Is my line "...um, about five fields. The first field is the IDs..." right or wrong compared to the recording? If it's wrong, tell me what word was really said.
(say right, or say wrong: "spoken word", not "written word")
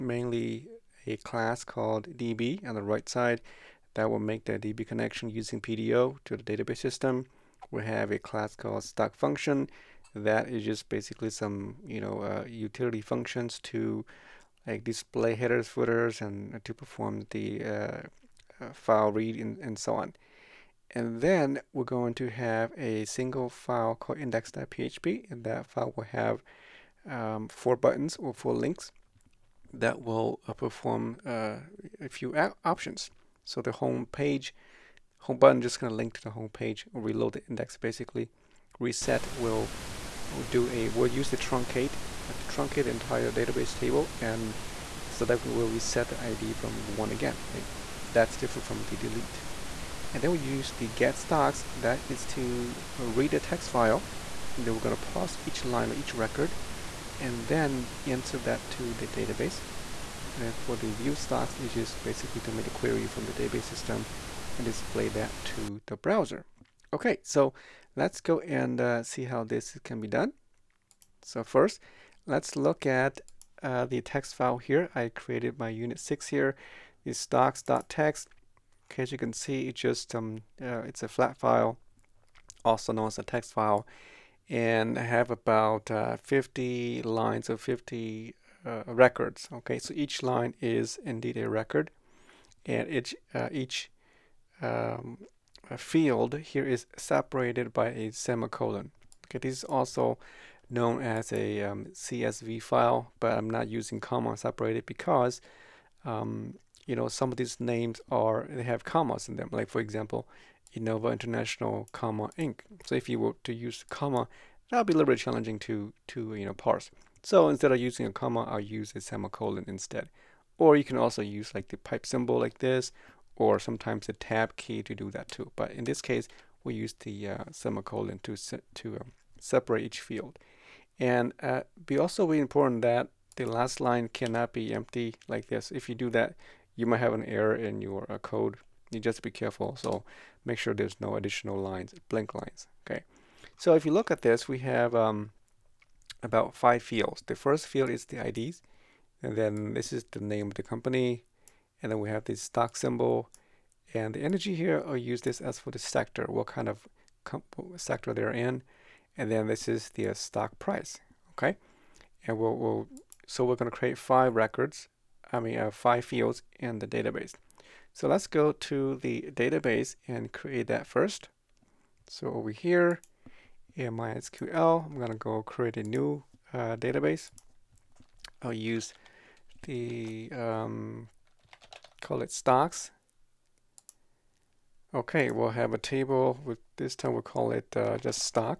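right.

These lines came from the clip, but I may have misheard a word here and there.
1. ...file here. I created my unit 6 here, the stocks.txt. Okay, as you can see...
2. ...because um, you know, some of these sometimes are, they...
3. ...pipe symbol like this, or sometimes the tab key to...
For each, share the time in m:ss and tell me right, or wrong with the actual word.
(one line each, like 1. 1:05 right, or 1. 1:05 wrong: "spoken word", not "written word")
1. 1:14 right
2. 1:44 wrong: "names", not "sometimes"
3. 2:01 right.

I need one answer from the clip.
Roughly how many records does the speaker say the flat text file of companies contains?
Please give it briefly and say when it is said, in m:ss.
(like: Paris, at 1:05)
50, at 1:25.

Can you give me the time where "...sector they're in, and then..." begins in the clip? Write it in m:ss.
2:37.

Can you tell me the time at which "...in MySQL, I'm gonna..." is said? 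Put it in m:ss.
2:53.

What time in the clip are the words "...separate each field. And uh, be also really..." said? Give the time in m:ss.
2:09.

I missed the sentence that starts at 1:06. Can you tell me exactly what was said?
Okay, so let's go and uh, see how this can be done.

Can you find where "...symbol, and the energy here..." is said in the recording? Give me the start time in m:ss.
2:32.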